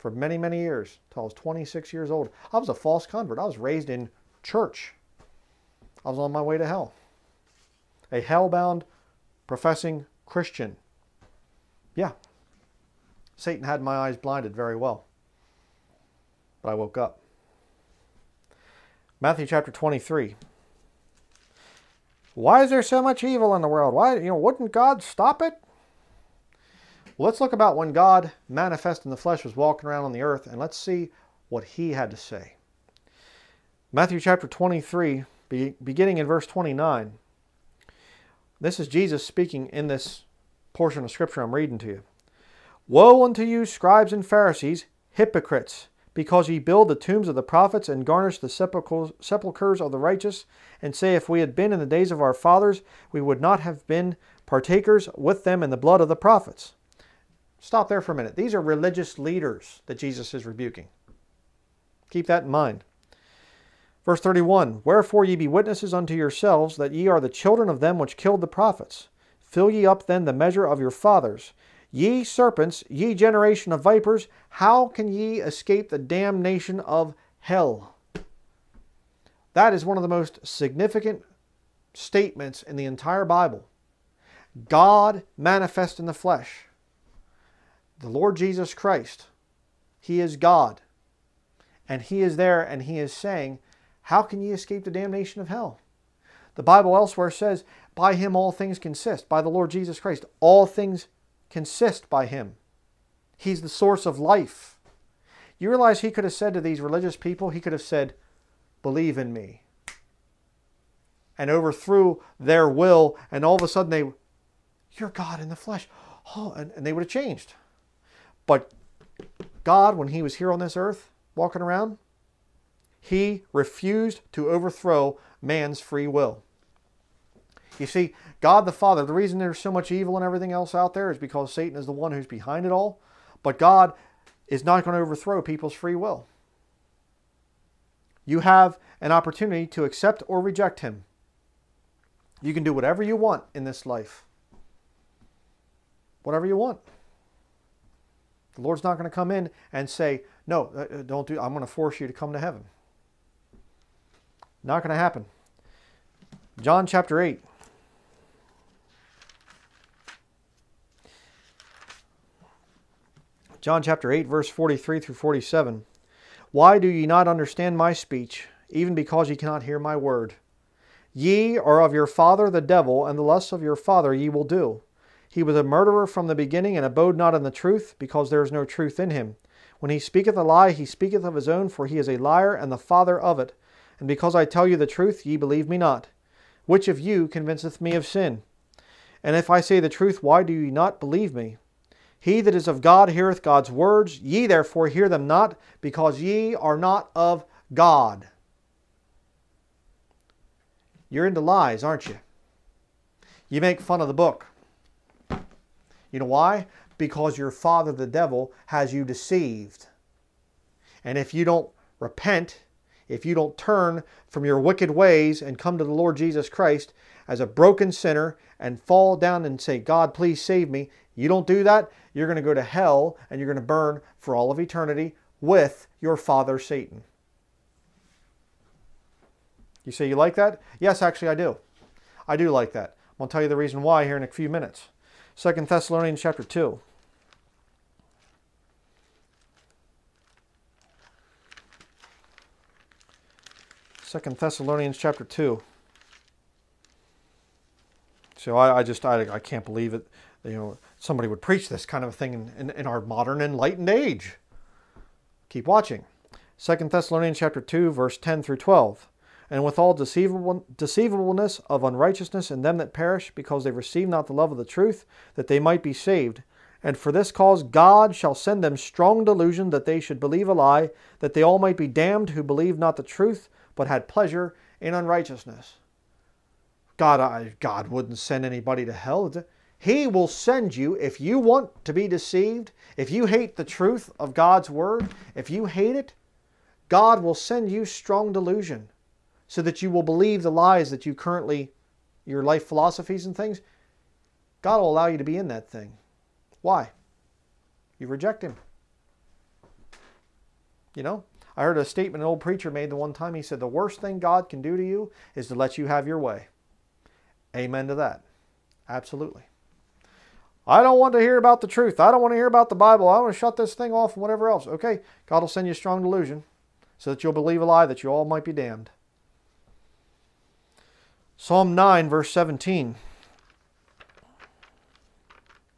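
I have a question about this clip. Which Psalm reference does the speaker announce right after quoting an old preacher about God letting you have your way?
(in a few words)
Psalm 9:17.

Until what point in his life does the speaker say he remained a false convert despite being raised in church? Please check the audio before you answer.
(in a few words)
26 years old.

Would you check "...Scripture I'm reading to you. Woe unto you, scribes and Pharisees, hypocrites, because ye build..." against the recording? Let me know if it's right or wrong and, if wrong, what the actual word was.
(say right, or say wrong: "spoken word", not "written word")
right.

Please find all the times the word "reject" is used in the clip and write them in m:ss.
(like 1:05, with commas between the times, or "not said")
2:20, 4:58.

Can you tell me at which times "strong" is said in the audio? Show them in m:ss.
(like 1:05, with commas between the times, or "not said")
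4:28, 4:47, 5:15.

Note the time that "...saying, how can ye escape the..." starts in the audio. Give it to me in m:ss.
1:33.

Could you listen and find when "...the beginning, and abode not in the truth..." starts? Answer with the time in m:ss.
2:56.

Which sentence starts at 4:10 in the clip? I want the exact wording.
You know, somebody would preach this kind of thing in, in, in our modern enlightened age.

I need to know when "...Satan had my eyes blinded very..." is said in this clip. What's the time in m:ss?
0:13.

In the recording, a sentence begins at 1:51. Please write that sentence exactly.
And overthrew their will, and all of a sudden they, You're God in the flesh.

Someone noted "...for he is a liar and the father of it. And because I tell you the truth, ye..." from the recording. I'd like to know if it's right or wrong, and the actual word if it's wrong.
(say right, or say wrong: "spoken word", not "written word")
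right.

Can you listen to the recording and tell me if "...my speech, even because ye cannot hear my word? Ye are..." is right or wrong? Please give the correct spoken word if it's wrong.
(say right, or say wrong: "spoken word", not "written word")
right.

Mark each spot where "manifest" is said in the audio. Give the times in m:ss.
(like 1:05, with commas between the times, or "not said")
0:28, 1:25.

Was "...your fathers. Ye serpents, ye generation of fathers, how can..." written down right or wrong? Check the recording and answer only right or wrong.
wrong.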